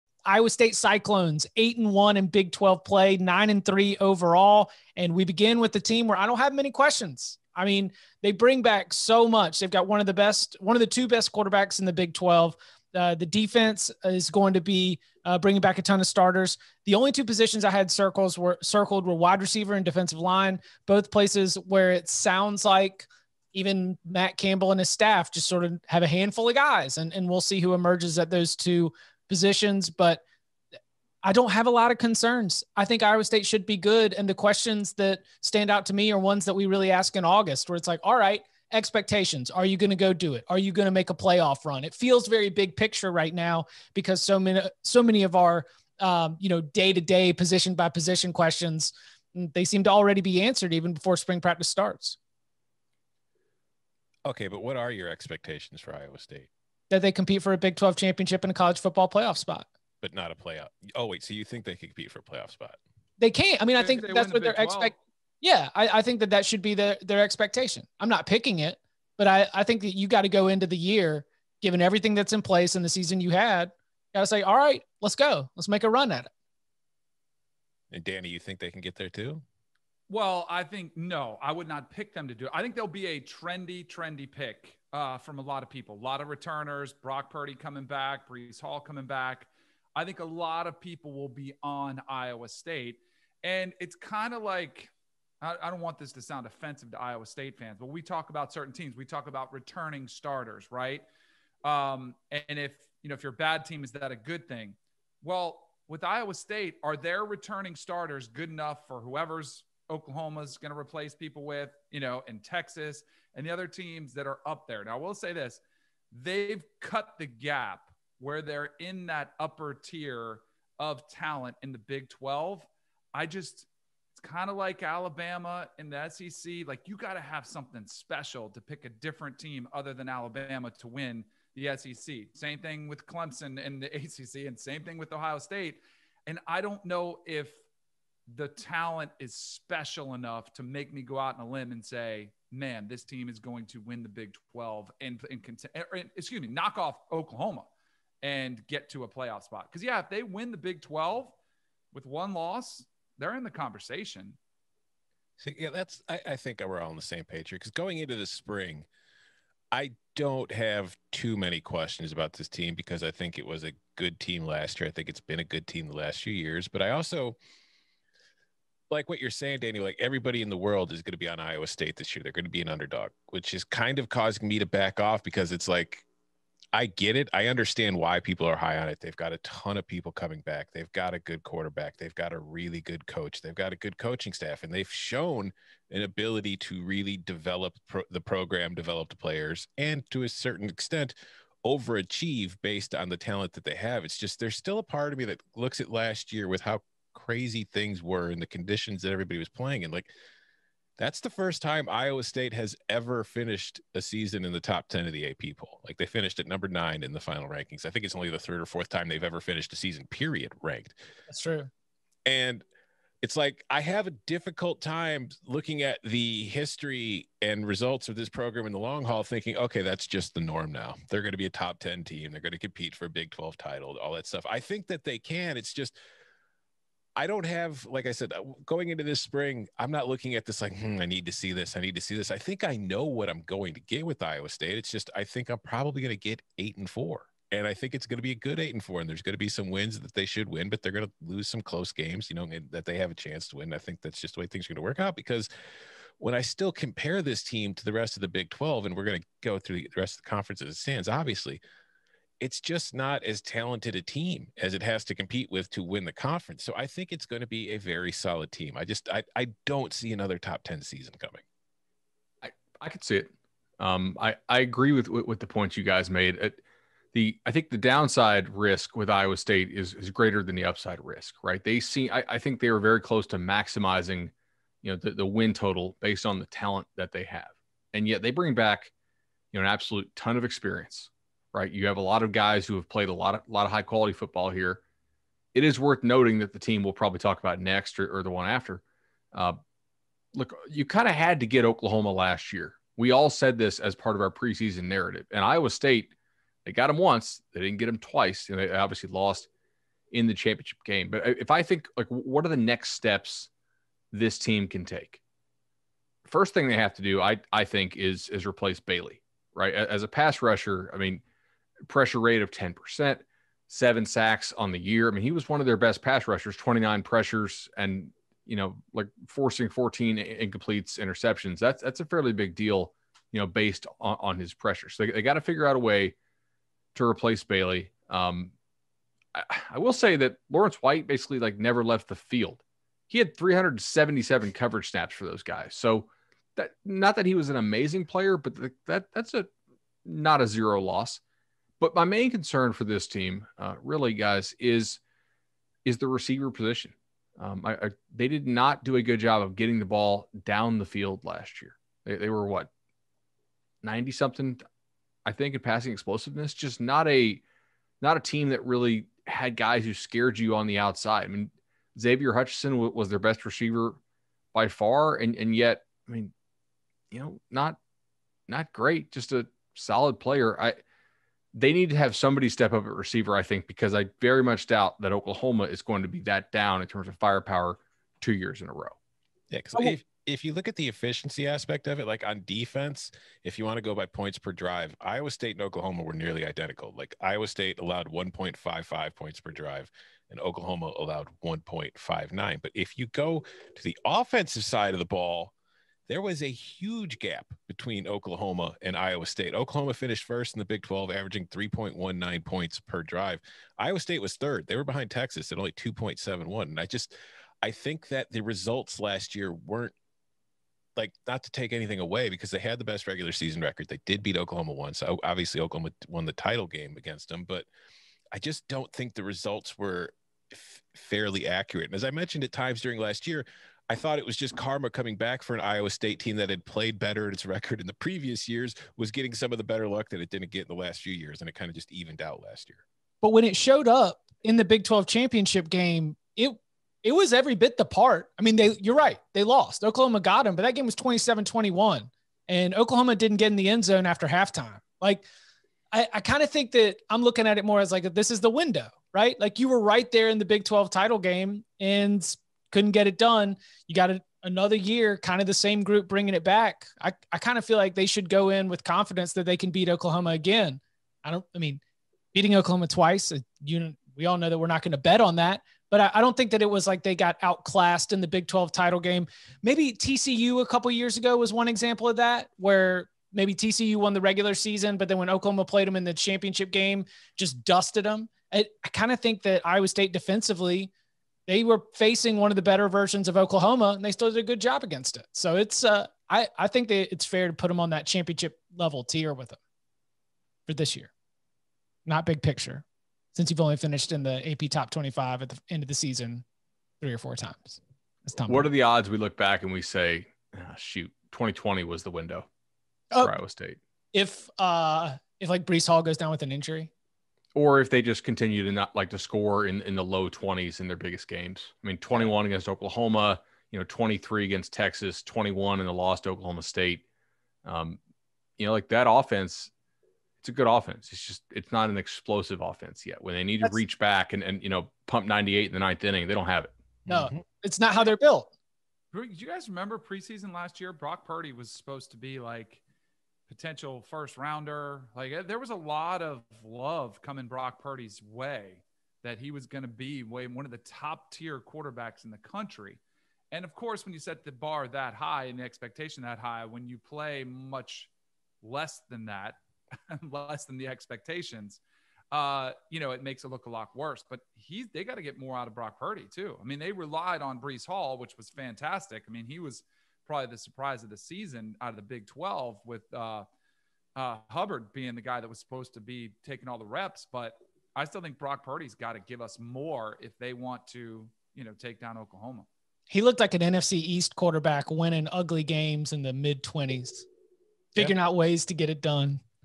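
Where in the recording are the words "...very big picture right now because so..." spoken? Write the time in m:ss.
0:42.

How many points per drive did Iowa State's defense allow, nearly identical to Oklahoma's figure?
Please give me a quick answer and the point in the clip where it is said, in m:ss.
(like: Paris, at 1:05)
1.55, at 6:28.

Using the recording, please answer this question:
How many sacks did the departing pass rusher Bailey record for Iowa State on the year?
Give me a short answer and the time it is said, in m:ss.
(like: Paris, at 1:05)
7, at 5:13.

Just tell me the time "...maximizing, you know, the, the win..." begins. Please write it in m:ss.
4:33.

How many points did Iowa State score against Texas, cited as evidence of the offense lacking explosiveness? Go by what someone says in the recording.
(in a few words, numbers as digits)
23.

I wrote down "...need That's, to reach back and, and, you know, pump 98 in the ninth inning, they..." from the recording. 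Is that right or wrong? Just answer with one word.
right.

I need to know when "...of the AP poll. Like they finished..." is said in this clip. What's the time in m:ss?
3:25.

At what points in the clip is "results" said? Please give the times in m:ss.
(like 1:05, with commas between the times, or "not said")
3:37, 6:48, 6:59.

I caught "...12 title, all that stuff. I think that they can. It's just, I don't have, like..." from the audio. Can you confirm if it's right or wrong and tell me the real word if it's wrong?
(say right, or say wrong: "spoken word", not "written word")
right.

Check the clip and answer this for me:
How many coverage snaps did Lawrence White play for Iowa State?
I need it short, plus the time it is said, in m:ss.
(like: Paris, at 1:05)
377, at 5:33.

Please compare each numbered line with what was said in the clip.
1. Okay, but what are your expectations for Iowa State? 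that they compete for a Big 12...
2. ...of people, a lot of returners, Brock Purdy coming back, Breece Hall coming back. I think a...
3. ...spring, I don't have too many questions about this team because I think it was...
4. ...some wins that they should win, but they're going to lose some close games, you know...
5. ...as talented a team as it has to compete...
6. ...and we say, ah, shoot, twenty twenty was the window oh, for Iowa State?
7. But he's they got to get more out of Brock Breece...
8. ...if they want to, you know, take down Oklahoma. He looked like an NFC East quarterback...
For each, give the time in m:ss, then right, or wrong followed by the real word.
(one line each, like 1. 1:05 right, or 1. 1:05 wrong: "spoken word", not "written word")
1. 0:54 right
2. 1:25 right
3. 2:38 right
4. 3:59 right
5. 4:13 right
6. 8:19 right
7. 9:14 wrong: "Purdy", not "Breece"
8. 9:30 right.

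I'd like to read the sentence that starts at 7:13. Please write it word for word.
But when it showed up in the Big 12 championship game, it it was every bit the part.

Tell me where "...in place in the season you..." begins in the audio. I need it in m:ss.
1:12.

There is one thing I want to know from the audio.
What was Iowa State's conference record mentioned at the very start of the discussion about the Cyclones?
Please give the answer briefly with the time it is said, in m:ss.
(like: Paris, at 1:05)
8-1, at 0:01.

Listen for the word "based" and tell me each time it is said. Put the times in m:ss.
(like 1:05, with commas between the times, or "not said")
3:12, 4:36, 5:23.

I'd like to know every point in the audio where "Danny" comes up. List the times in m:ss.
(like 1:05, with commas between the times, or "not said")
1:18, 2:49.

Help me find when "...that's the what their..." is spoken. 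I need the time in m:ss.
1:04.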